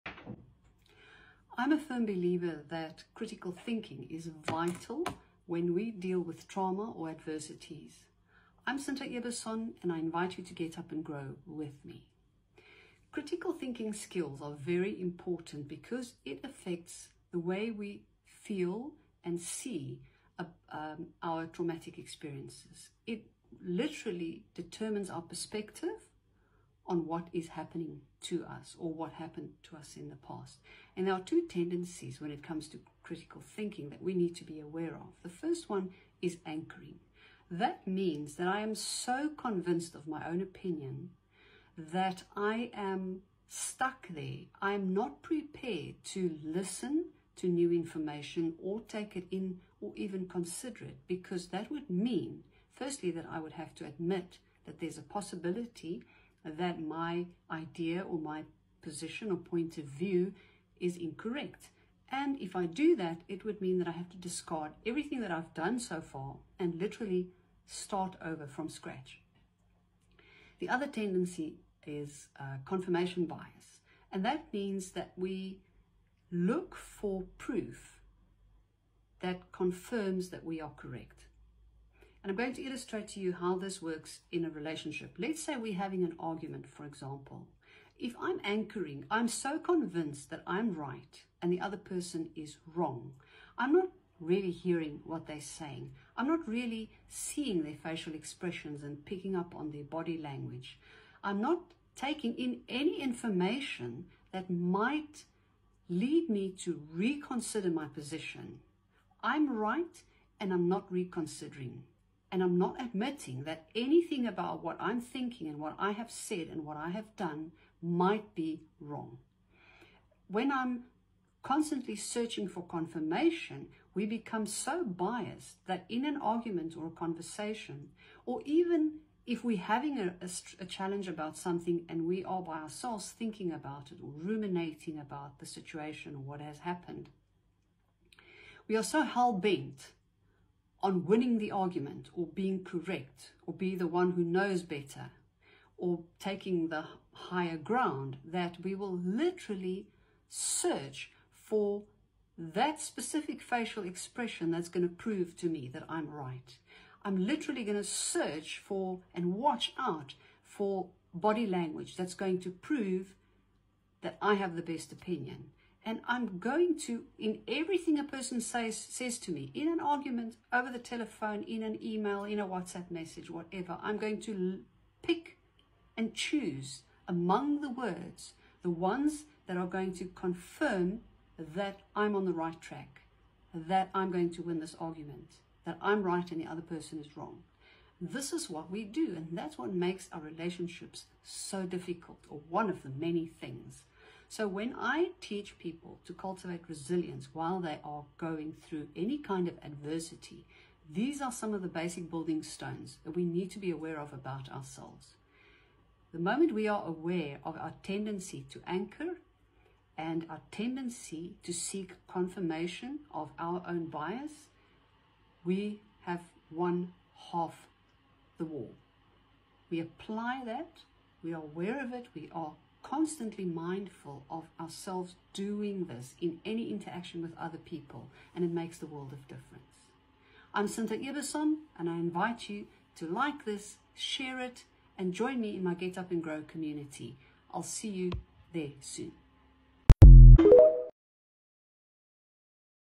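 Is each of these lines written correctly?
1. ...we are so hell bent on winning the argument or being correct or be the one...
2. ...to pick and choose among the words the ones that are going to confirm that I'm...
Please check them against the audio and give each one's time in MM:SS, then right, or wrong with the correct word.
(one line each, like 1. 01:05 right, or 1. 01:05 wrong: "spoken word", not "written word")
1. 02:18 right
2. 02:54 right.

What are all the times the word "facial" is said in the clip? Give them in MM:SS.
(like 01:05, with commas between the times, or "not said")
01:37, 02:33.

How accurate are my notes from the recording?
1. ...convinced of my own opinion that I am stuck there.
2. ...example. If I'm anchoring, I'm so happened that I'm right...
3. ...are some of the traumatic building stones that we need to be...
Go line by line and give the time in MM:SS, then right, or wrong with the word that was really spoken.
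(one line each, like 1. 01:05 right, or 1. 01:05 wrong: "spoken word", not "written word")
1. 00:39 right
2. 01:26 wrong: "convinced", not "happened"
3. 03:21 wrong: "basic", not "traumatic".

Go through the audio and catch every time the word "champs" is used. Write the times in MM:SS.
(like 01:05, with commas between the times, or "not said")
not said.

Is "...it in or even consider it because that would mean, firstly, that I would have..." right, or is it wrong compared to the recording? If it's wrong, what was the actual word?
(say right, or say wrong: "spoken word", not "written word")
right.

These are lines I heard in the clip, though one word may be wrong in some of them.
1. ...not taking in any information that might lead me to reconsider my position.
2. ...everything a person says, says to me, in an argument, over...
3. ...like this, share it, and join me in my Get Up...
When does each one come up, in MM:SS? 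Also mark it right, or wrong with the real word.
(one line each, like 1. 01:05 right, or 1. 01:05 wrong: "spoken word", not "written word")
1. 01:41 right
2. 02:47 right
3. 03:53 right.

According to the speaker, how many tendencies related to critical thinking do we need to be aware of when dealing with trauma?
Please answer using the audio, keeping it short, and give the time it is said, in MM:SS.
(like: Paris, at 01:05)
2, at 00:31.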